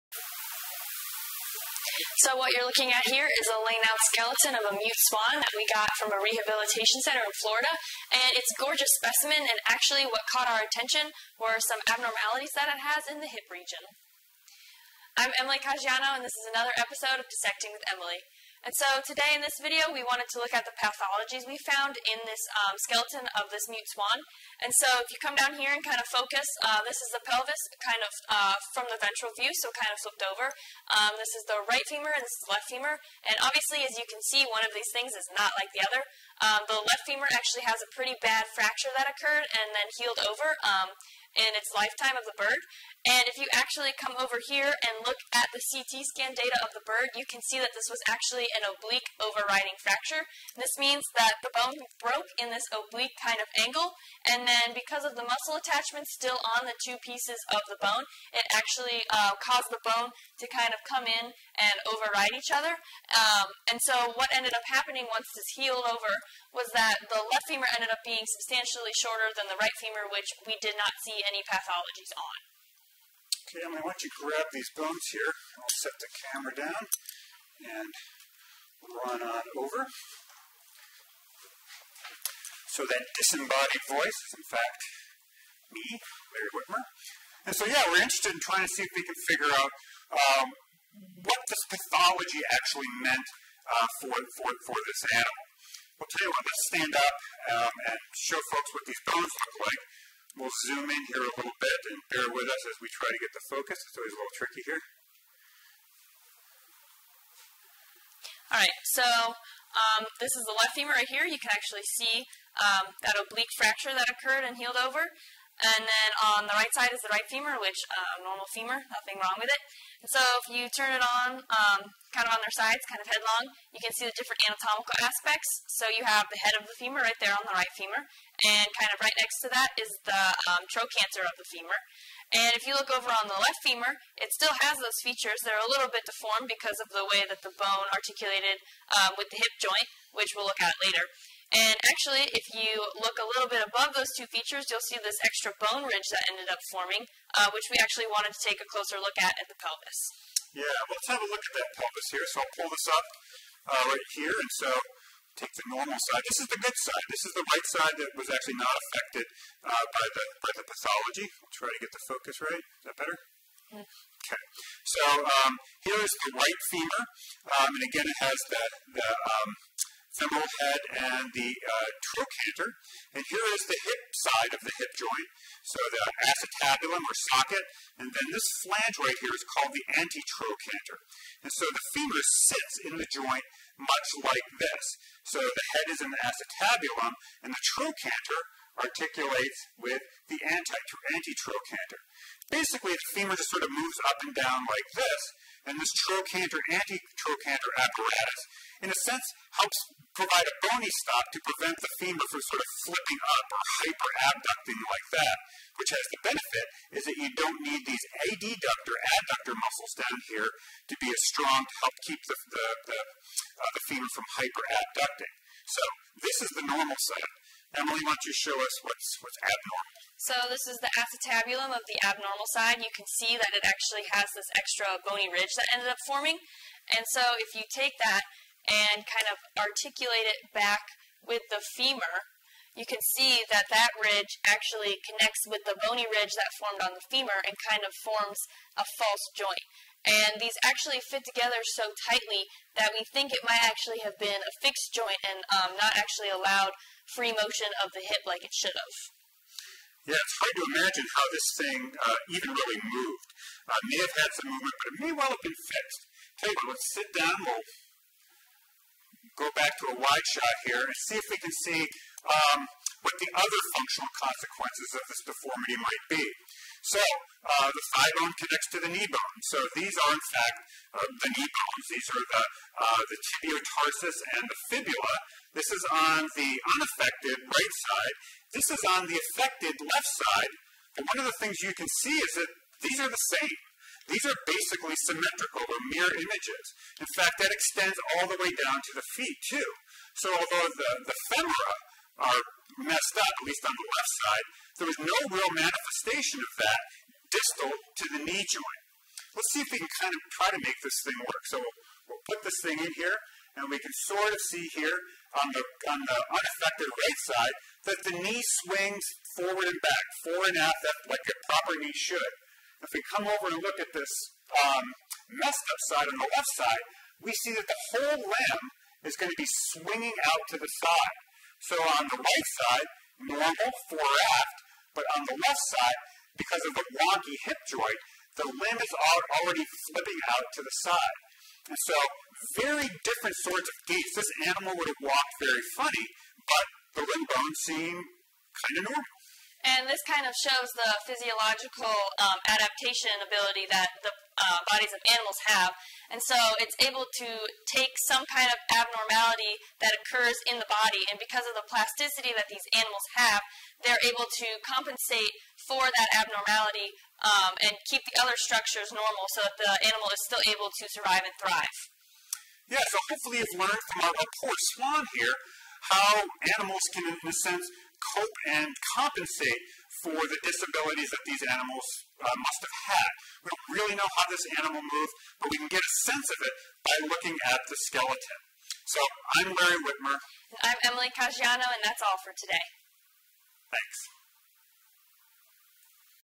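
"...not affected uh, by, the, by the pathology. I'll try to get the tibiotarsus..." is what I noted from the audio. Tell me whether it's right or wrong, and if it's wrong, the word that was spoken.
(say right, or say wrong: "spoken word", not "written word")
wrong: "focus", not "tibiotarsus".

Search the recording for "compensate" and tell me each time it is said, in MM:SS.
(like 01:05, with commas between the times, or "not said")
05:54, 06:08.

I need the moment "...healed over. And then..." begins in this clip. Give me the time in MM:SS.
01:54.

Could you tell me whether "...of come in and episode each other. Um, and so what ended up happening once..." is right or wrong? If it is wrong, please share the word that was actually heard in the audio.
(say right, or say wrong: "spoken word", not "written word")
wrong: "override", not "episode".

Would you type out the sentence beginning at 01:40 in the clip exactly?
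We'll zoom in here a little bit and bear with us as we try to get the focus.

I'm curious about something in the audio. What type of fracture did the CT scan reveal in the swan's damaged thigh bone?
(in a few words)
Oblique overriding fracture.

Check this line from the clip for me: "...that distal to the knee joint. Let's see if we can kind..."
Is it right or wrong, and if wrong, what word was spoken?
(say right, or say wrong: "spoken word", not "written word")
right.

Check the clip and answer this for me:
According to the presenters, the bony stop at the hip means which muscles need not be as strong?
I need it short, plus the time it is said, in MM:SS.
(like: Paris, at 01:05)
Adductor muscles, at 03:28.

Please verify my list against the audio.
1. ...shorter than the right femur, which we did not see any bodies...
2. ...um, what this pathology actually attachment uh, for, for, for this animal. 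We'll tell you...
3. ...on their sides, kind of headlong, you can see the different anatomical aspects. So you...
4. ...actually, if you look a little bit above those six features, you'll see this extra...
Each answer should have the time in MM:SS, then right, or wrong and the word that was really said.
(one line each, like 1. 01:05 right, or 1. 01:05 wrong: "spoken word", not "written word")
1. 01:08 wrong: "pathologies", not "bodies"
2. 01:30 wrong: "meant", not "attachment"
3. 02:02 right
4. 02:21 wrong: "two", not "six".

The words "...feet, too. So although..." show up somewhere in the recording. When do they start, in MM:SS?
04:49.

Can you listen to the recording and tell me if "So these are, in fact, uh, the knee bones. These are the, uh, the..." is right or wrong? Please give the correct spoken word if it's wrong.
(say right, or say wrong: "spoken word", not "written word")
right.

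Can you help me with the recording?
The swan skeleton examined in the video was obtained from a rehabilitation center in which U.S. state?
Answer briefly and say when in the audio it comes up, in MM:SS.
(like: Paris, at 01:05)
Florida, at 00:07.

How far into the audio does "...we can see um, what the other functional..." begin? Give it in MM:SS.
04:21.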